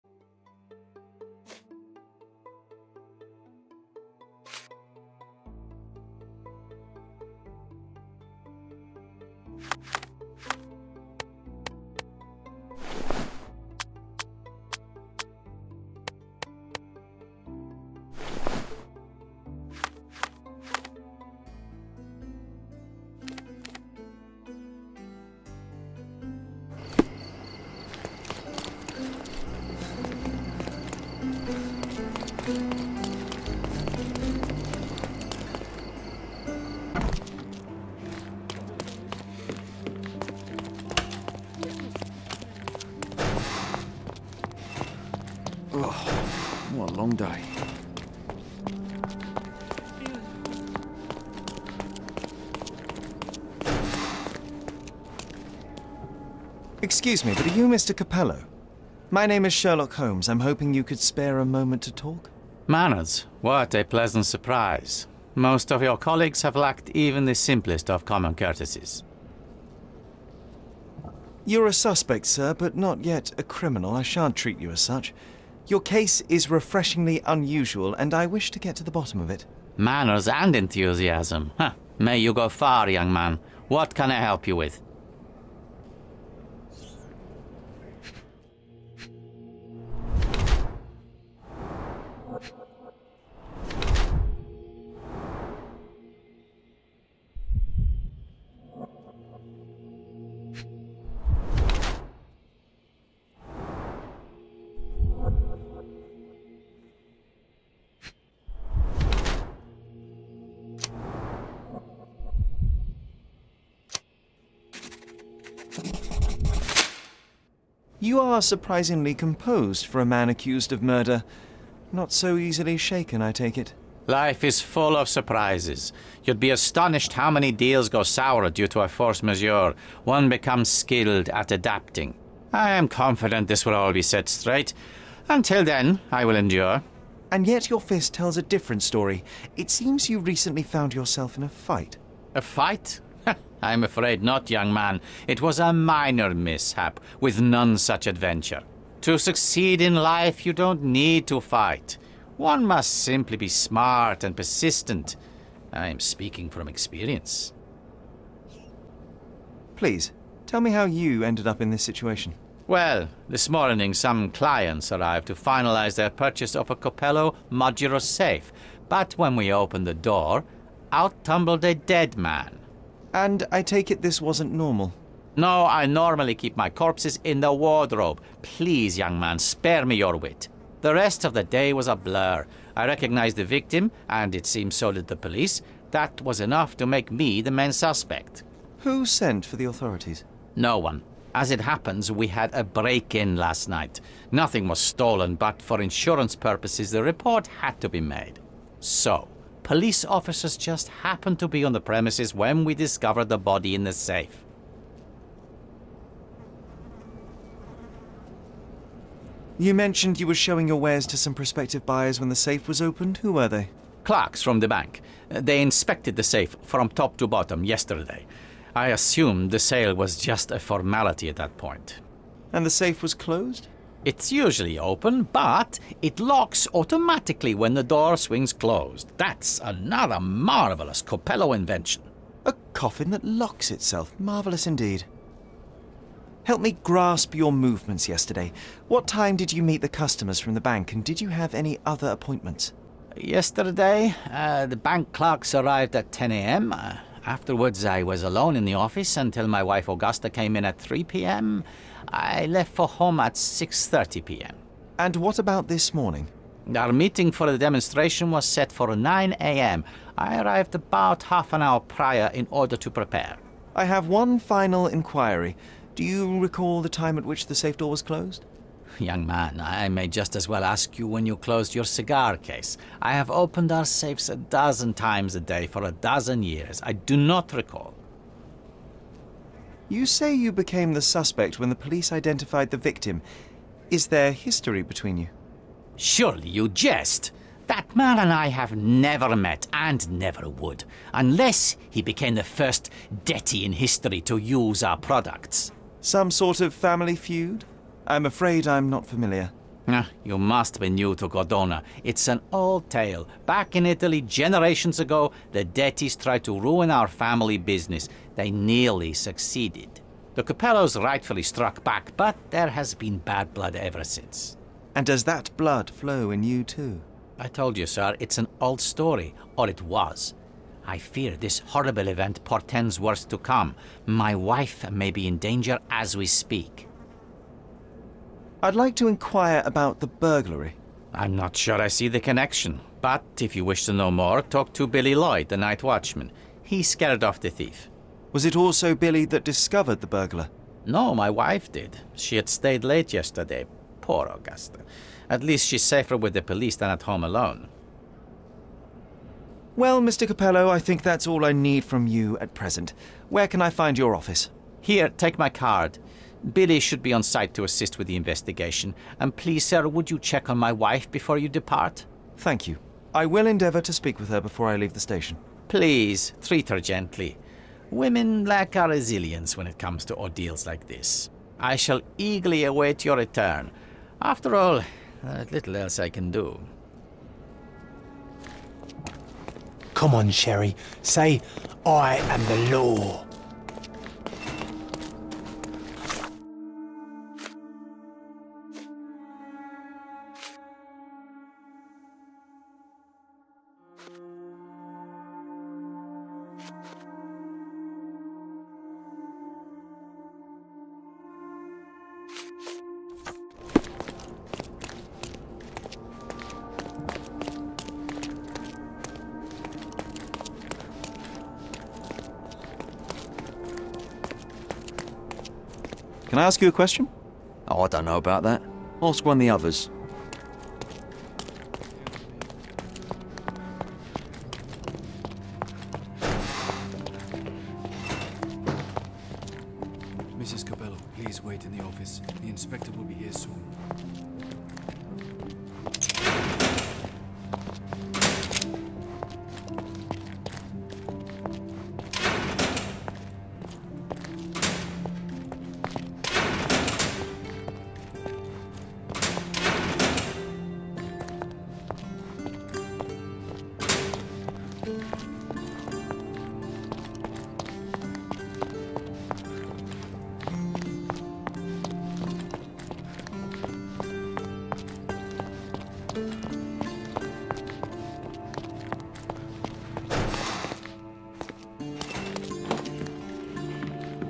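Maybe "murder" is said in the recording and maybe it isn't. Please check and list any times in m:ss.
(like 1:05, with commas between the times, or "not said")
2:00.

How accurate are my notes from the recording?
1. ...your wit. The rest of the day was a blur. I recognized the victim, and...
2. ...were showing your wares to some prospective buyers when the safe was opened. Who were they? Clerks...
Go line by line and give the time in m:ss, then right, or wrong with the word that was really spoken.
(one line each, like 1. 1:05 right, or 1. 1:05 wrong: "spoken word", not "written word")
1. 2:59 right
2. 3:30 right.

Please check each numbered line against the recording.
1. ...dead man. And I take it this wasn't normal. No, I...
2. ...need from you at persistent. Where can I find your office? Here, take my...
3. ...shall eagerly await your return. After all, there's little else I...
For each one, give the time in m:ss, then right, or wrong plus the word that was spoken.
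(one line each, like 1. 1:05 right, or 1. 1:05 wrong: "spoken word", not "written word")
1. 2:51 right
2. 5:51 wrong: "present", not "persistent"
3. 6:11 right.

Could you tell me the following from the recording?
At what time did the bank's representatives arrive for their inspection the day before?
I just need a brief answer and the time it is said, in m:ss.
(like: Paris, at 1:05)
10 a.m., at 4:06.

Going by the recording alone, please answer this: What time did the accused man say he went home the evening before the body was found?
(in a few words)
6.30 p.m.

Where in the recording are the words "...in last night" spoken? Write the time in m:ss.
3:13.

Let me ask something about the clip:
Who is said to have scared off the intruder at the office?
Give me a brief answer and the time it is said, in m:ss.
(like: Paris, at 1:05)
Billy Lloyd, at 5:34.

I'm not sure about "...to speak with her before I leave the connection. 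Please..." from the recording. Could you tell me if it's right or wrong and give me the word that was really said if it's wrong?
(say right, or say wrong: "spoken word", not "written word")
wrong: "station", not "connection".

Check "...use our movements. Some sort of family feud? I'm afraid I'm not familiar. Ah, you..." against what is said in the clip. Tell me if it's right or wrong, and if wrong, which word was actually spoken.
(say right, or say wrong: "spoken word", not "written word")
wrong: "products", not "movements".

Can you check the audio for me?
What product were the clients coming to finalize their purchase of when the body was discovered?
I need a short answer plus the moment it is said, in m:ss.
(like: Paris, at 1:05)
Capello modular safe, at 2:46.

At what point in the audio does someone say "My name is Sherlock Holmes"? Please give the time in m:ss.
0:59.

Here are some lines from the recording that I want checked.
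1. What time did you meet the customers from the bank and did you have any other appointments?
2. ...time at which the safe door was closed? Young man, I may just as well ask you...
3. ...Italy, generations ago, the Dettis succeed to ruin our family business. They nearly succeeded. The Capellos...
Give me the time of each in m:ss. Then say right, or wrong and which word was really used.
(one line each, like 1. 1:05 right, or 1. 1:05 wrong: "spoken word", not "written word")
1. 3:58 right
2. 4:26 right
3. 5:03 wrong: "tried", not "succeed".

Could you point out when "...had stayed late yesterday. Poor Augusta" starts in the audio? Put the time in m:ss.
5:42.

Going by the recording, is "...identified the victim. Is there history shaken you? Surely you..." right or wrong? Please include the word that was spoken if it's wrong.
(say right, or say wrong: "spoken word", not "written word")
wrong: "between", not "shaken".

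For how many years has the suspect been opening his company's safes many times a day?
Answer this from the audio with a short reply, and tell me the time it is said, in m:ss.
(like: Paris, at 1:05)
12, at 4:35.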